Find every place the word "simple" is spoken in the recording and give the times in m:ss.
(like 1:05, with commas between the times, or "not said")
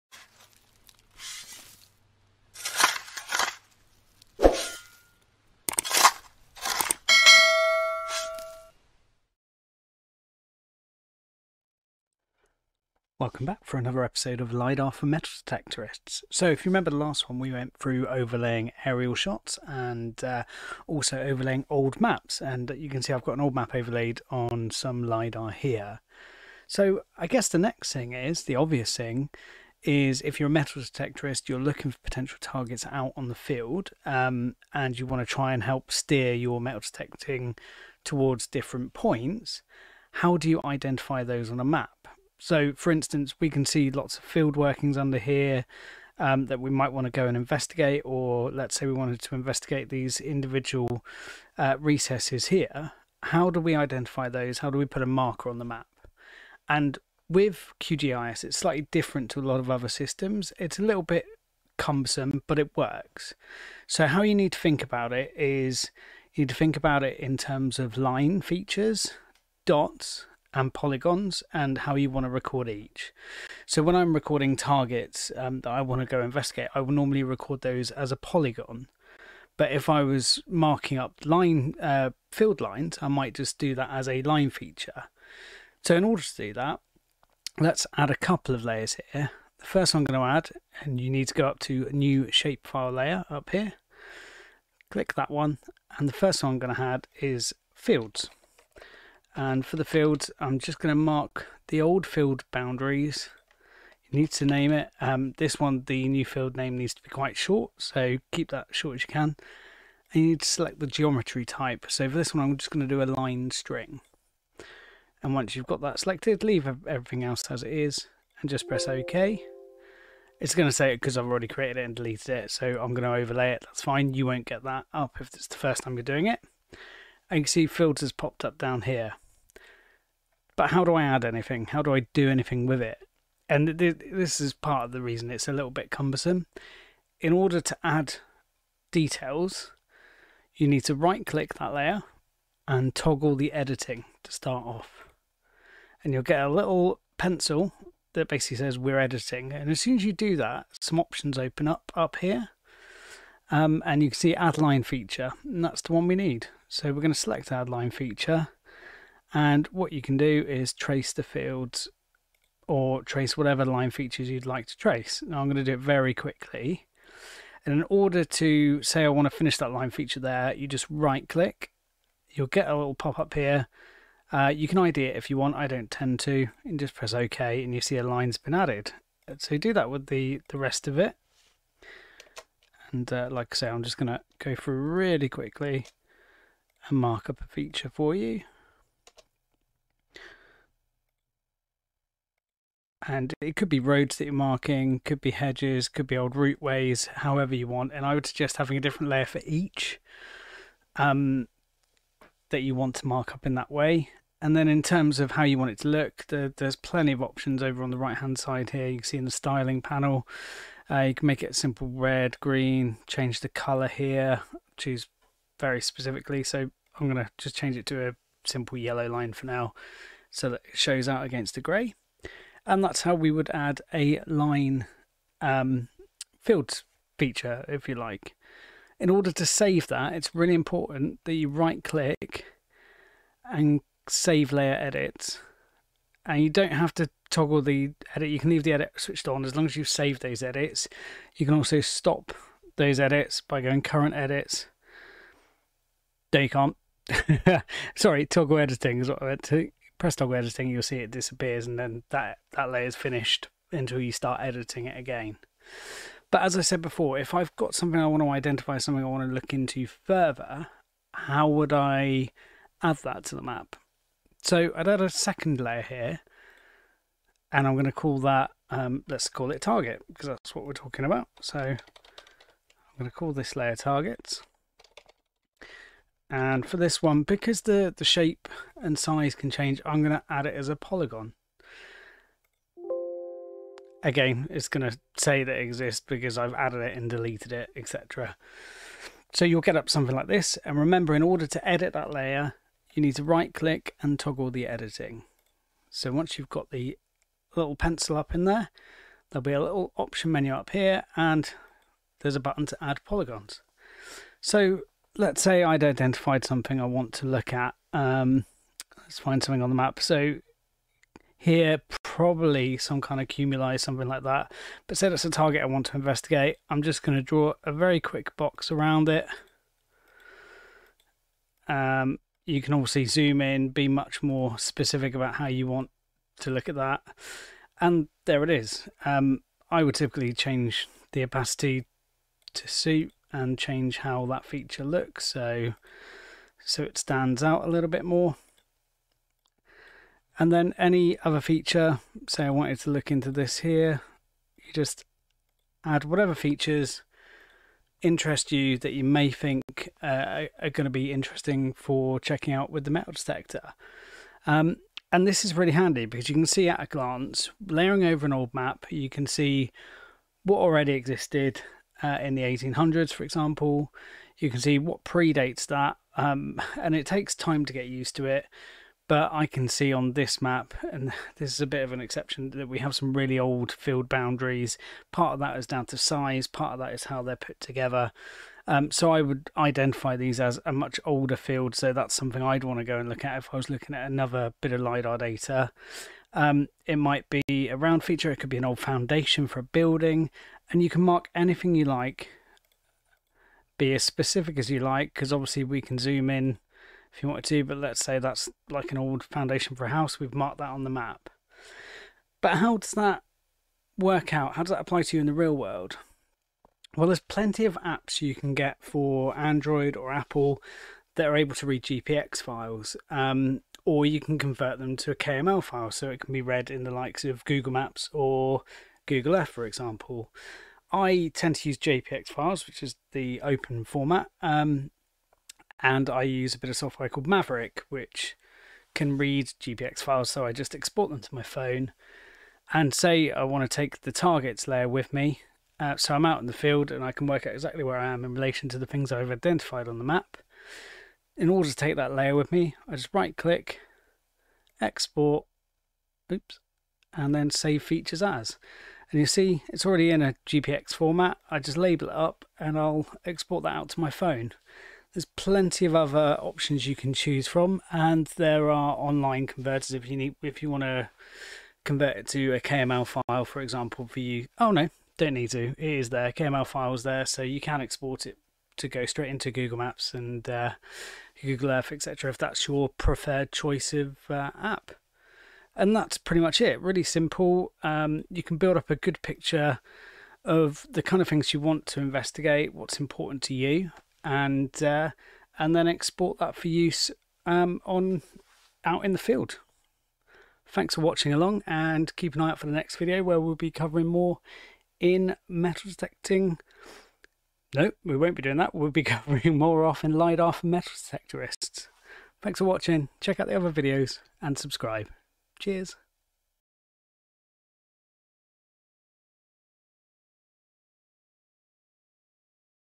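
3:31, 3:38, 7:57.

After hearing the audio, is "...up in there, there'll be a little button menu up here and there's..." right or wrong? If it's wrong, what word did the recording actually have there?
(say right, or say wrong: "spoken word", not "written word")
wrong: "option", not "button".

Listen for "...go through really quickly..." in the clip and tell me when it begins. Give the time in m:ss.
3:04.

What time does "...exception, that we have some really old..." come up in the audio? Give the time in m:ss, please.
6:12.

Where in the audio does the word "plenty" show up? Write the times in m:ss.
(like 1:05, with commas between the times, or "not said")
3:26, 6:47, 7:35.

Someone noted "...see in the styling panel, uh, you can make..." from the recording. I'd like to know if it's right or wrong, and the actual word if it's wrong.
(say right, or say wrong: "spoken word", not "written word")
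right.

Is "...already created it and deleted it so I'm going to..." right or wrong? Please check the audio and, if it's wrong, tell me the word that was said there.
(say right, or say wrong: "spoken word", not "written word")
right.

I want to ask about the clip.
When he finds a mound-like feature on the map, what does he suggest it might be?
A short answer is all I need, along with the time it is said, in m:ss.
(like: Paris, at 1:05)
tumuli, at 5:13.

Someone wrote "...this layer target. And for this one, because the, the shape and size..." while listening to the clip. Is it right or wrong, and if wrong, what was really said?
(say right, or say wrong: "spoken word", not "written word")
right.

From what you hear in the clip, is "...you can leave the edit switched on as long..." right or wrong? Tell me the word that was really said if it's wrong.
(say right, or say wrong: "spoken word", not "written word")
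right.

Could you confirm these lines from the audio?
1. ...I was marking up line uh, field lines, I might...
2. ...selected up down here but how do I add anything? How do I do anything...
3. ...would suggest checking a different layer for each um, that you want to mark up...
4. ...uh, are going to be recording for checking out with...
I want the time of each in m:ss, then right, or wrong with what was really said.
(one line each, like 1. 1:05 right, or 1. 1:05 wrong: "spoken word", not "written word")
1. 1:19 right
2. 2:08 wrong: "popped", not "selected"
3. 3:18 wrong: "having", not "checking"
4. 5:50 wrong: "interesting", not "recording".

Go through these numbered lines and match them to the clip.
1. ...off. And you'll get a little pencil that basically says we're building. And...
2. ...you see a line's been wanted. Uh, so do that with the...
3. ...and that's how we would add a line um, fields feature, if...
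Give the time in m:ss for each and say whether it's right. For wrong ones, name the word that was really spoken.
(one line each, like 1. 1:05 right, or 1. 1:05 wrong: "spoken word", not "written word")
1. 2:24 wrong: "editing", not "building"
2. 2:57 wrong: "added", not "wanted"
3. 3:42 right.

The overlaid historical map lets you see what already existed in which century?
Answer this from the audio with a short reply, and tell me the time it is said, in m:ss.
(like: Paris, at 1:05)
1800s, at 6:02.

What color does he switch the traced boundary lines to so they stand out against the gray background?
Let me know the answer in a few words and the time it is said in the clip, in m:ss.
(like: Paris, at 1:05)
yellow, at 3:38.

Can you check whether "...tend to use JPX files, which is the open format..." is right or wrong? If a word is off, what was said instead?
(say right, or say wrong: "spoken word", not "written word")
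right.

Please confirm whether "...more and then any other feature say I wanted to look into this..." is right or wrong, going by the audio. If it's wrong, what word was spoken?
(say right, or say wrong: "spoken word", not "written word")
right.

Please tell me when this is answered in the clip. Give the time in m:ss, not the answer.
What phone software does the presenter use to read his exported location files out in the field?
7:07.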